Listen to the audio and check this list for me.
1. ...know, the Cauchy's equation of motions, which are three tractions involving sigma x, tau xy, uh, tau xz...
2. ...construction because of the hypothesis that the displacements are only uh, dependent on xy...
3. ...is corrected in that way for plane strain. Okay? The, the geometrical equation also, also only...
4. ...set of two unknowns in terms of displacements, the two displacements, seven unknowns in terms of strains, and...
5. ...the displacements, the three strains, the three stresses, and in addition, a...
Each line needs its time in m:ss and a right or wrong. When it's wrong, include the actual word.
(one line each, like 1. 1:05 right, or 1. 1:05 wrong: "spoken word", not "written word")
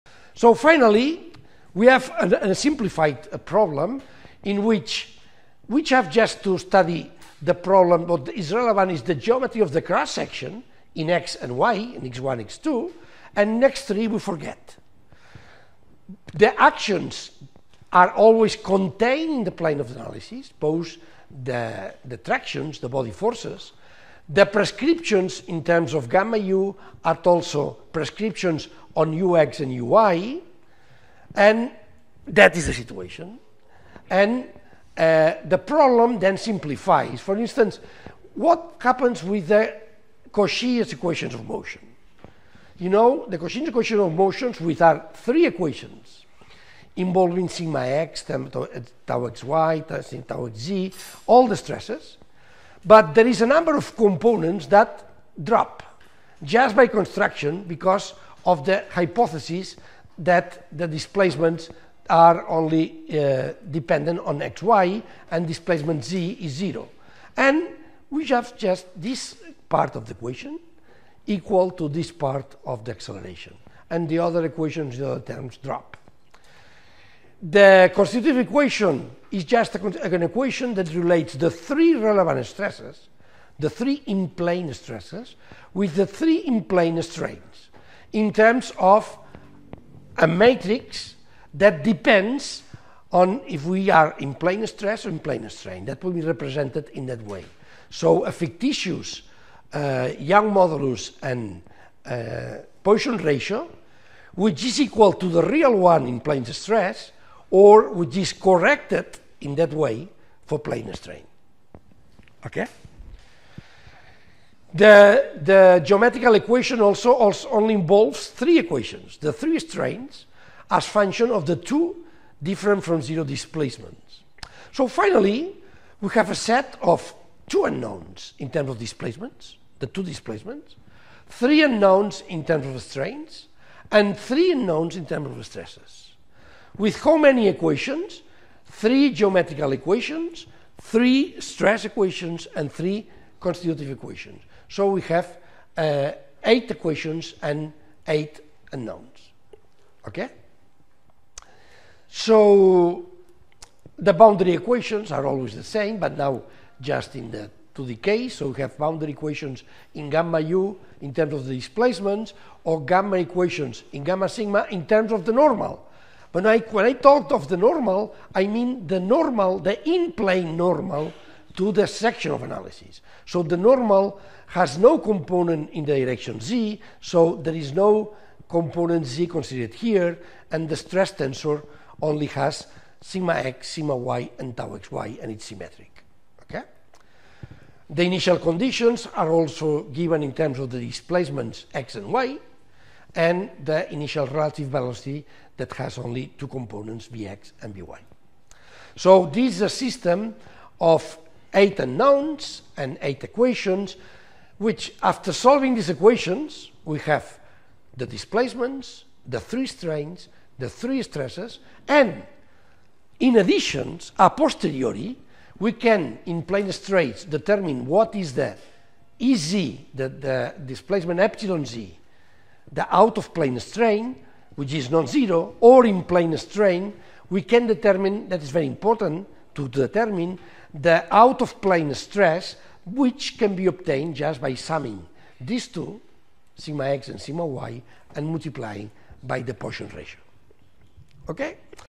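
1. 0:42 wrong: "equations", not "tractions"
2. 0:56 right
3. 1:48 right
4. 2:06 wrong: "three", not "seven"
5. 3:27 right.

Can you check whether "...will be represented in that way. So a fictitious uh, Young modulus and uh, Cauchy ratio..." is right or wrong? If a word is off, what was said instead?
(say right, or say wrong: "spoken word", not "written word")
wrong: "Poisson", not "Cauchy".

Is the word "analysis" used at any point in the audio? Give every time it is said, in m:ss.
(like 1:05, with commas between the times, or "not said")
0:19, 2:52.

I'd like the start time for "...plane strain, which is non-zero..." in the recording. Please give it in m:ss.
3:43.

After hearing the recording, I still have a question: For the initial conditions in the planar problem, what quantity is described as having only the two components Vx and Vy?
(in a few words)
initial relative velocity.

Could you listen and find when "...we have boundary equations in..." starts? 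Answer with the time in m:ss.
2:38.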